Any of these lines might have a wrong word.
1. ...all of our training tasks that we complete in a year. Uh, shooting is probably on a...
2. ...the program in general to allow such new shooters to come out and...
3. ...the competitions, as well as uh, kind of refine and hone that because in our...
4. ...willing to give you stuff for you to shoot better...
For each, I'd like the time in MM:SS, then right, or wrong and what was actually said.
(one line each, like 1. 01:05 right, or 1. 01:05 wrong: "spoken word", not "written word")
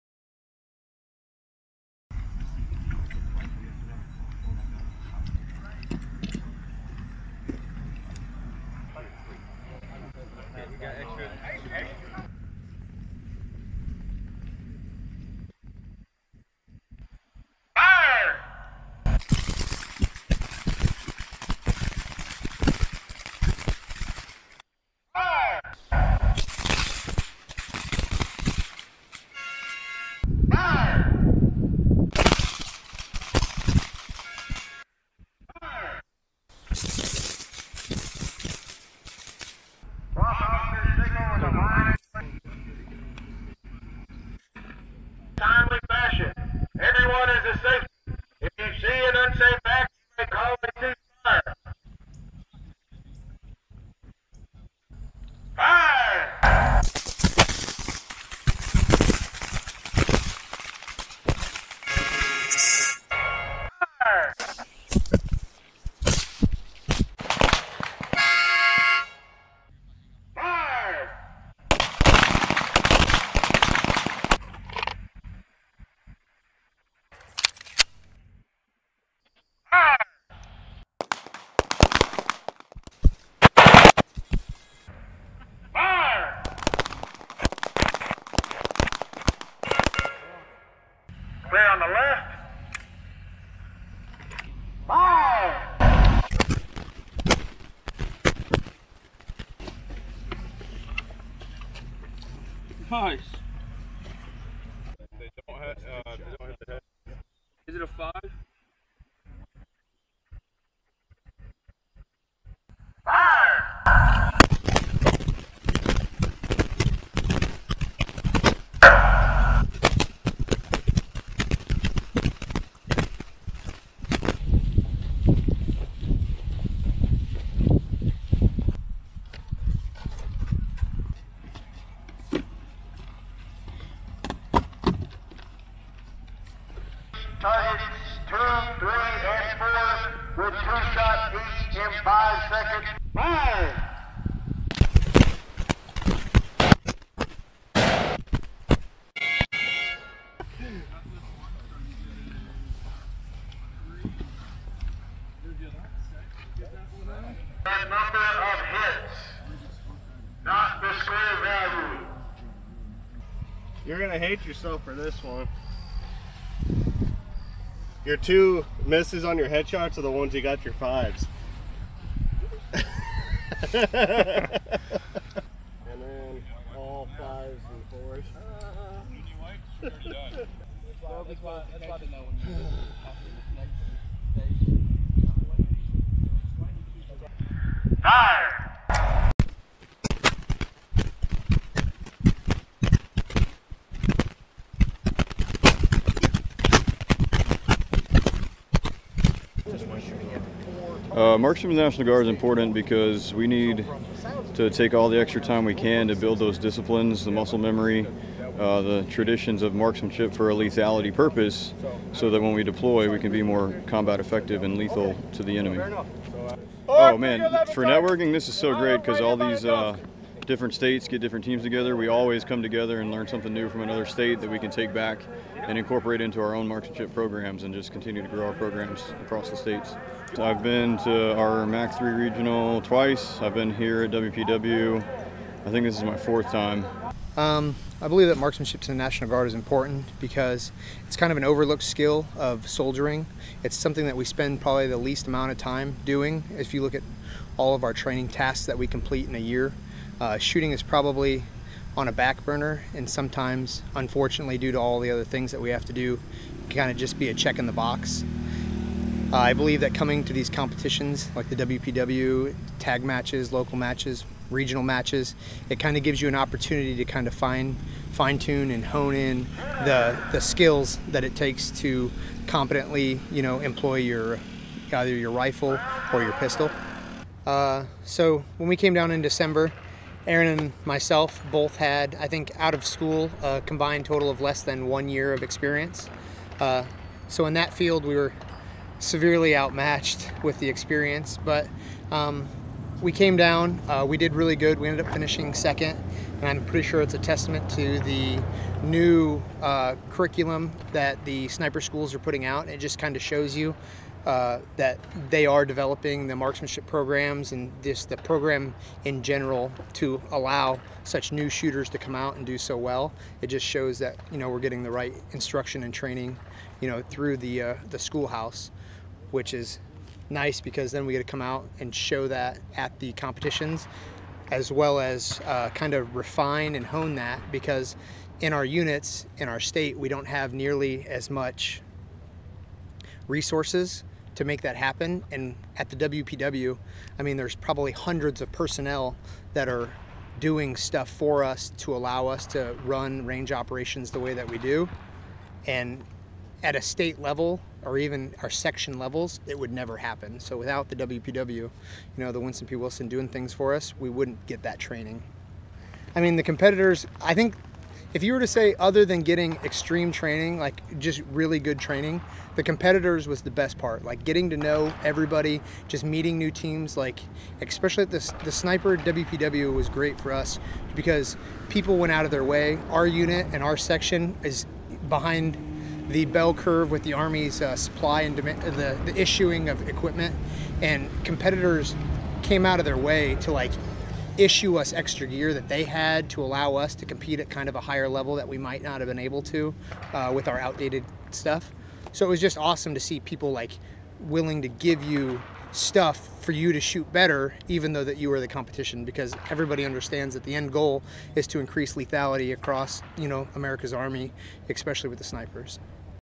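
1. 04:07 right
2. 05:08 right
3. 05:22 right
4. 06:34 right.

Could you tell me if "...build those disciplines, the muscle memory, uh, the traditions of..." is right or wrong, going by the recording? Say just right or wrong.
right.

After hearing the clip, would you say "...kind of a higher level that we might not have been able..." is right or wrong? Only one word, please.
right.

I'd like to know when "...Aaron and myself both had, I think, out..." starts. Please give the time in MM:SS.
04:40.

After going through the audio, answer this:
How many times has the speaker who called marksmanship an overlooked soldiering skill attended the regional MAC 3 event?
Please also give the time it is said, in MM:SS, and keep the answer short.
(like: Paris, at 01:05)
twice, at 03:52.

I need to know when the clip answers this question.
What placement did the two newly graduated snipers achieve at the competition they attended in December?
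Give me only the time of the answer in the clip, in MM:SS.
04:55.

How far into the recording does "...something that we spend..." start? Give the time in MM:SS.
04:03.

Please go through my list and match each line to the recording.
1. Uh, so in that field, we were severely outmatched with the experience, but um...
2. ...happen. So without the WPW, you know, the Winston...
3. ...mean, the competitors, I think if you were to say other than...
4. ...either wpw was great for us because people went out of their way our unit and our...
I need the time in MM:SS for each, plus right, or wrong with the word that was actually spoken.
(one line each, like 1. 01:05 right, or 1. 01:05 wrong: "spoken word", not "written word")
1. 04:46 right
2. 05:49 right
3. 05:56 right
4. 06:08 wrong: "sniper", not "either".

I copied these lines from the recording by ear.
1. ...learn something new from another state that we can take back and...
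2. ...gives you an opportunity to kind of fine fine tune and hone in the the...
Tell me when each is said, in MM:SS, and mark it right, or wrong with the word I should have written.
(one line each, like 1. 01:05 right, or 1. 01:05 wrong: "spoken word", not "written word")
1. 03:43 right
2. 04:26 right.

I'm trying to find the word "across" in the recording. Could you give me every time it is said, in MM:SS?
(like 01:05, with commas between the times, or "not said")
03:49, 06:42.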